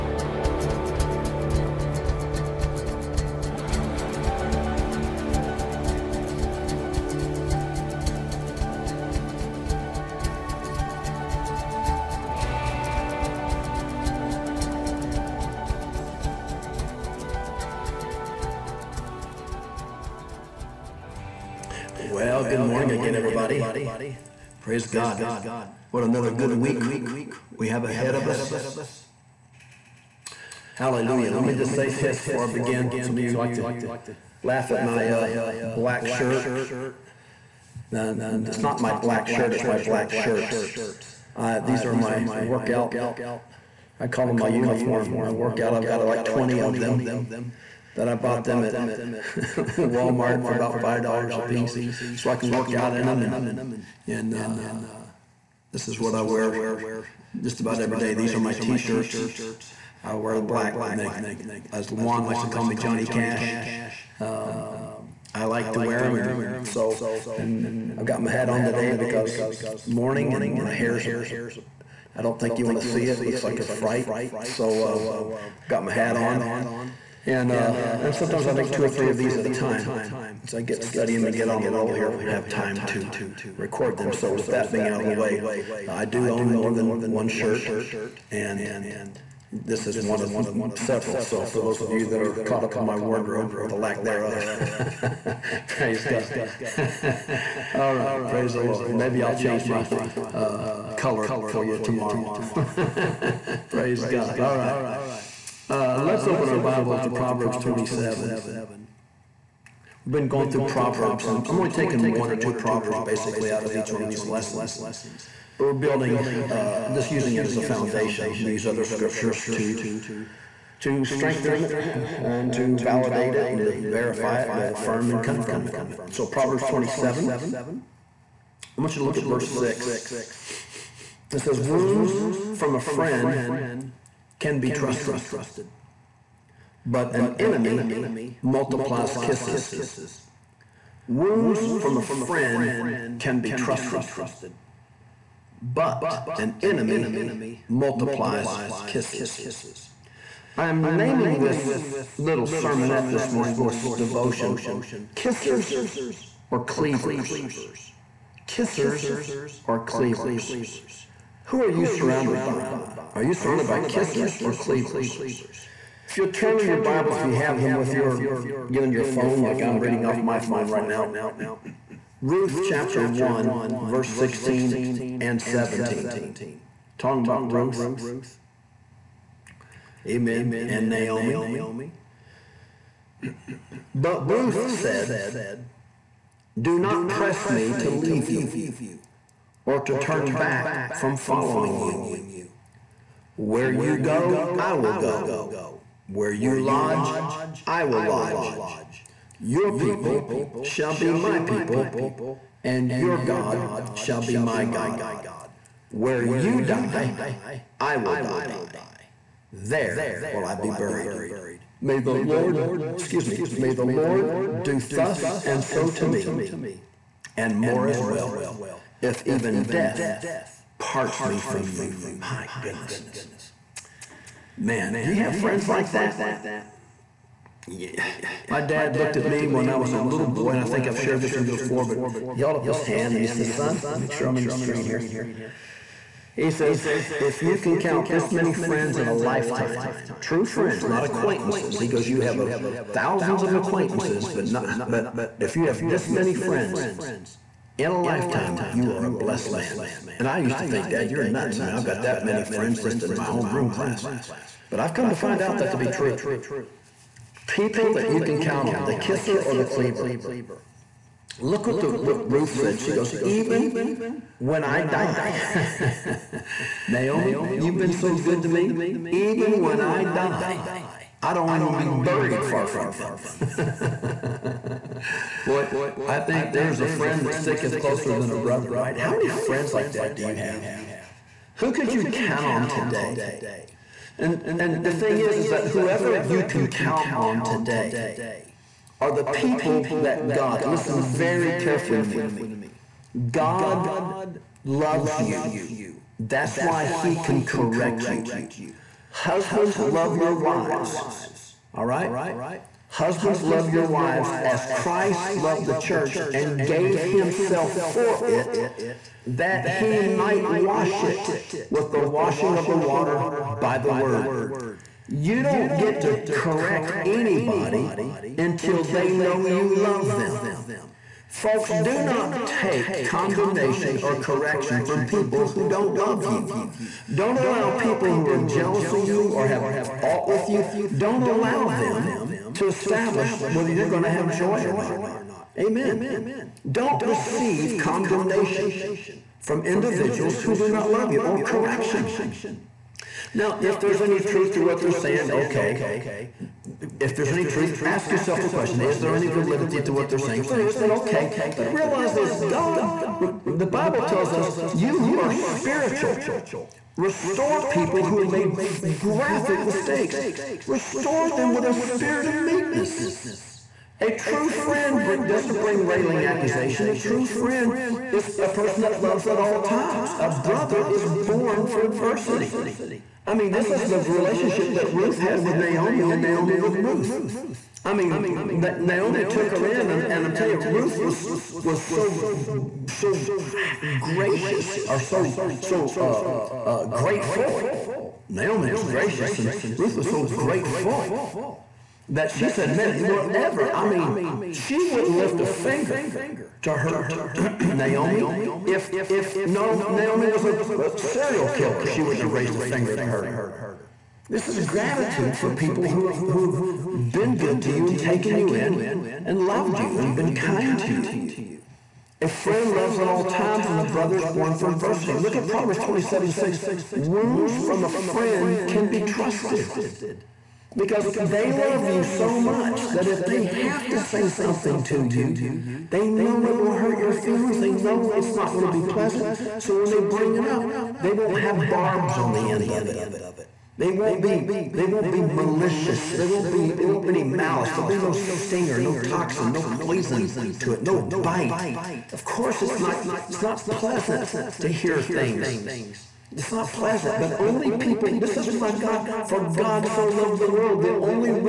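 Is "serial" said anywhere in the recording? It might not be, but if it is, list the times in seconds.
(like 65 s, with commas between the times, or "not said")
400 s.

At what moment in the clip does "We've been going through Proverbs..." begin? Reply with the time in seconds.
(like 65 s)
110 s.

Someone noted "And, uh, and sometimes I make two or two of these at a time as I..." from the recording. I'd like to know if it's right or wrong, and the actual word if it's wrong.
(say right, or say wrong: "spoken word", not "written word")
wrong: "three", not "two".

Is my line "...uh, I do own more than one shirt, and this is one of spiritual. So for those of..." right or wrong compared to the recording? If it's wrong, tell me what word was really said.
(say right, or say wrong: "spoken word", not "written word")
wrong: "several", not "spiritual".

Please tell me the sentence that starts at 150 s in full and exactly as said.
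I'm naming this little sermonette this morning, little devotion, Kissers or Cleavers.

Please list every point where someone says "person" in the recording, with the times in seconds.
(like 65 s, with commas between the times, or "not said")
368 s.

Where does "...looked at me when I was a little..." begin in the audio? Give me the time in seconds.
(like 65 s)
228 s.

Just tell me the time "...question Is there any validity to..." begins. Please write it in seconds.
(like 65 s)
348 s.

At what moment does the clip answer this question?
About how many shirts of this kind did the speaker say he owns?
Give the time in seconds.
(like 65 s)
46 s.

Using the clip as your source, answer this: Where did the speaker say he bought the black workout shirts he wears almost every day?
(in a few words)
Walmart.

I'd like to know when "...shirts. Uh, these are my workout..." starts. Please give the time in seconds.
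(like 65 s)
40 s.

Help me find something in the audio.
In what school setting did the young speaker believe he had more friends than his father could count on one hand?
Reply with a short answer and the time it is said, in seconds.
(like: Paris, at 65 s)
homeroom class, at 253 s.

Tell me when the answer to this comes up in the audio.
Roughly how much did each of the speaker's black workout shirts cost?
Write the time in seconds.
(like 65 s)
50 s.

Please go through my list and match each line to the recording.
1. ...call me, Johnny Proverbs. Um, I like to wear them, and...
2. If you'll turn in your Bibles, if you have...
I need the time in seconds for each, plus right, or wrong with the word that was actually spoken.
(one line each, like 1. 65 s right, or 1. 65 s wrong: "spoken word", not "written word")
1. 62 s wrong: "Cash", not "Proverbs"
2. 166 s right.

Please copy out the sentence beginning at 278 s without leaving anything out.
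How many friends like that do you have?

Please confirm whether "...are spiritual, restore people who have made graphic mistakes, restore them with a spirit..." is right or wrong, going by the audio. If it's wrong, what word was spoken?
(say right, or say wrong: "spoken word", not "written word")
right.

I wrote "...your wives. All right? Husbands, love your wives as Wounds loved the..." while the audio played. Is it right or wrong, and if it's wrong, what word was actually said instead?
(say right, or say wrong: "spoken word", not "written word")
wrong: "Christ", not "Wounds".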